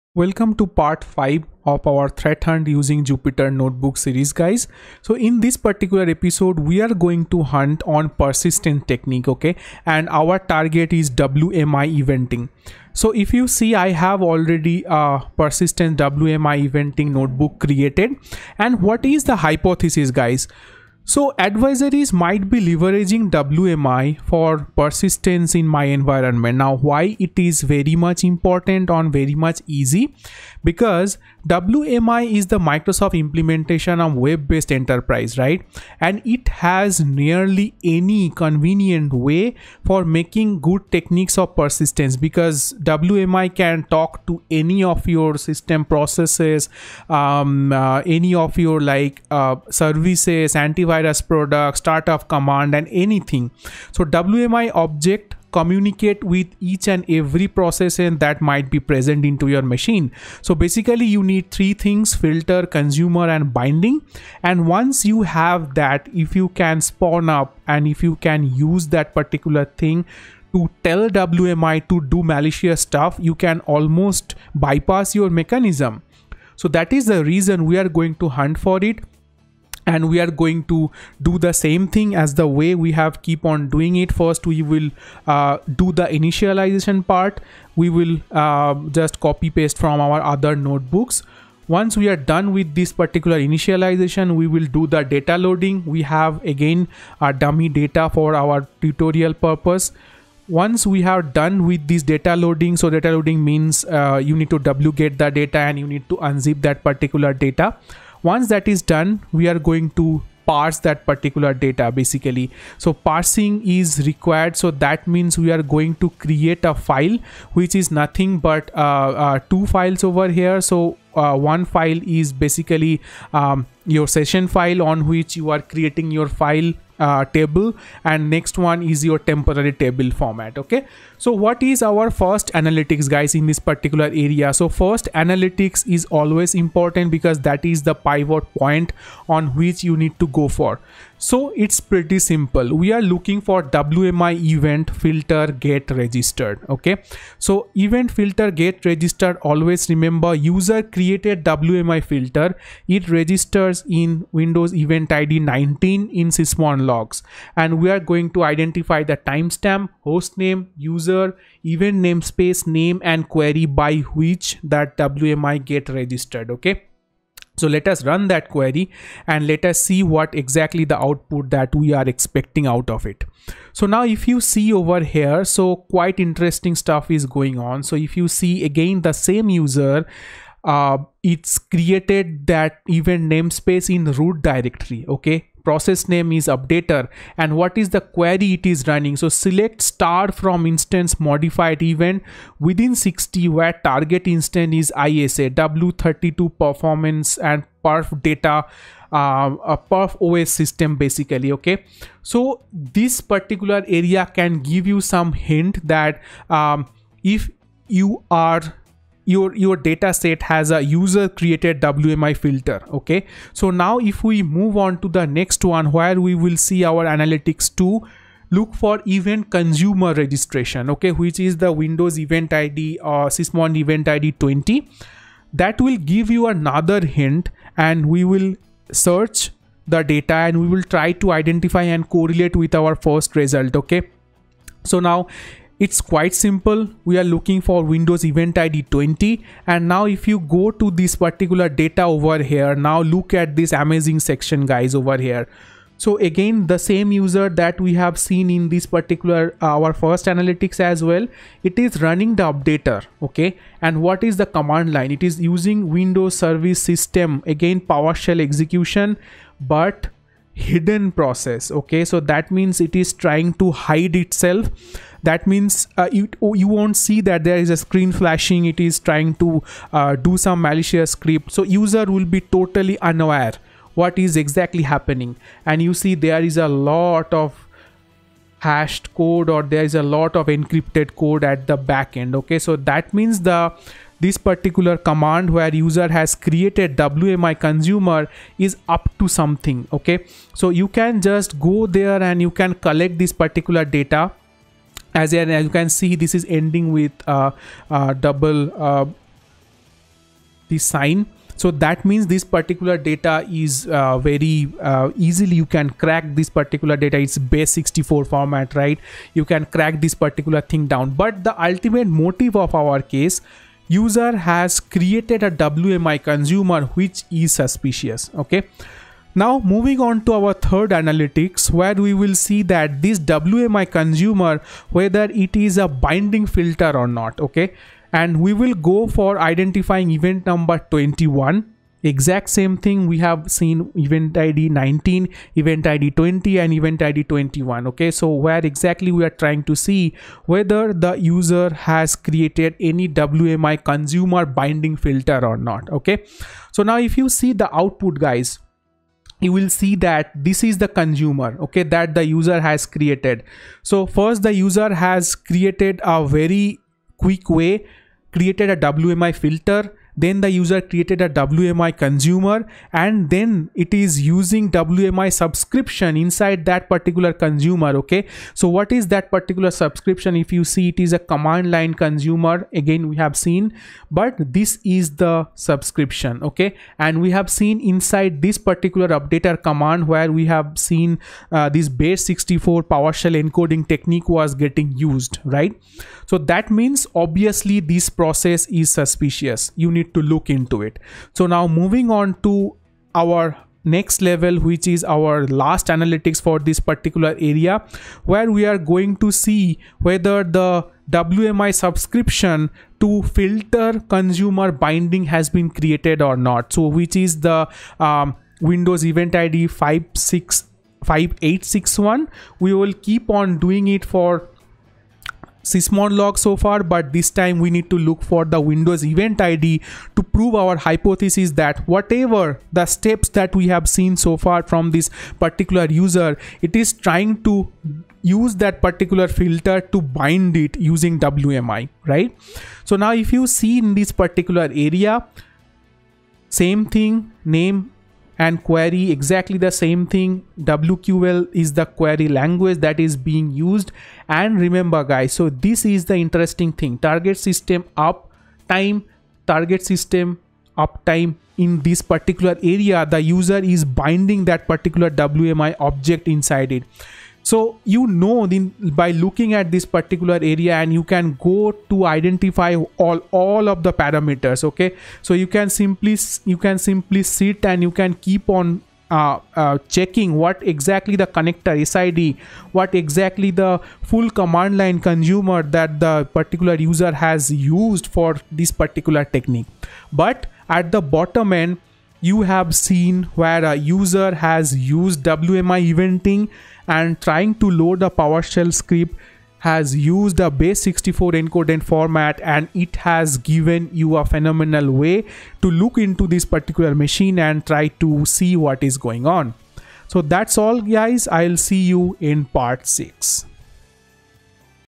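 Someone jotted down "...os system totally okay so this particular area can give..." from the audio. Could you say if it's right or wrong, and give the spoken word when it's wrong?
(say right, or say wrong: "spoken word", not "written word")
wrong: "basically", not "totally".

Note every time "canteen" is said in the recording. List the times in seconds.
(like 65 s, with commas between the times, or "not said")
not said.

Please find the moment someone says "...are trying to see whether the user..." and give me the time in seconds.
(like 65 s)
339 s.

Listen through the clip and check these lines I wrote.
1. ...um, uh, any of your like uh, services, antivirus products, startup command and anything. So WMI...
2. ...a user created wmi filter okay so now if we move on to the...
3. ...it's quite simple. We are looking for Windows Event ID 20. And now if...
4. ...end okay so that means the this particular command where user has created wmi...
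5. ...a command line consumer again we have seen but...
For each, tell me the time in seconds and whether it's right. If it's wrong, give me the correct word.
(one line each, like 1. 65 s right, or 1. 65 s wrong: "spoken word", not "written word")
1. 47 s right
2. 210 s right
3. 235 s right
4. 282 s right
5. 371 s right.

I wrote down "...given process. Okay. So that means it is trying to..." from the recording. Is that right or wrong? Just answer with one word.
wrong.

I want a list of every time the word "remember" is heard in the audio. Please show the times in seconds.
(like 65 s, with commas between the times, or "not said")
149 s, 444 s.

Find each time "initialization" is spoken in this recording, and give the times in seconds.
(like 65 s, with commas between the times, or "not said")
86 s, 93 s.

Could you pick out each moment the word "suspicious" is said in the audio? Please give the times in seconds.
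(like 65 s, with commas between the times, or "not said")
317 s, 388 s.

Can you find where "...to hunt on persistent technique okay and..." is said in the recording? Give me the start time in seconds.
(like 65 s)
7 s.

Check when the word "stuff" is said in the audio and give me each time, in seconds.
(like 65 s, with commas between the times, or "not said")
72 s, 176 s.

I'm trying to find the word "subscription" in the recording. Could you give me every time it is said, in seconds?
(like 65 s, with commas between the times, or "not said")
365 s, 369 s, 375 s, 401 s.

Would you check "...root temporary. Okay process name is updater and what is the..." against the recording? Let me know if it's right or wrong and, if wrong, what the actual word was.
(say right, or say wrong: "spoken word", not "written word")
wrong: "directory", not "temporary".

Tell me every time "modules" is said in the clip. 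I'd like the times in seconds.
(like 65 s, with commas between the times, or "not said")
not said.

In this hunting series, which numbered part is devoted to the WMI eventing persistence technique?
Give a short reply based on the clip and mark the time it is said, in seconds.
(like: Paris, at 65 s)
Part 5, at 0 s.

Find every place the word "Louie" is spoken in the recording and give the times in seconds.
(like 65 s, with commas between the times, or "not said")
not said.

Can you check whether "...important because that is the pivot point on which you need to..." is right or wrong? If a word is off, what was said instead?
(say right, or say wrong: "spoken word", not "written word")
right.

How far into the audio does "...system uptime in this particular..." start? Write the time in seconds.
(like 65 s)
449 s.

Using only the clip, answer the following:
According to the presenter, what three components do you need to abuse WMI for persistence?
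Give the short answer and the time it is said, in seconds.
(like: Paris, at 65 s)
Filter, consumer and binding, at 62 s.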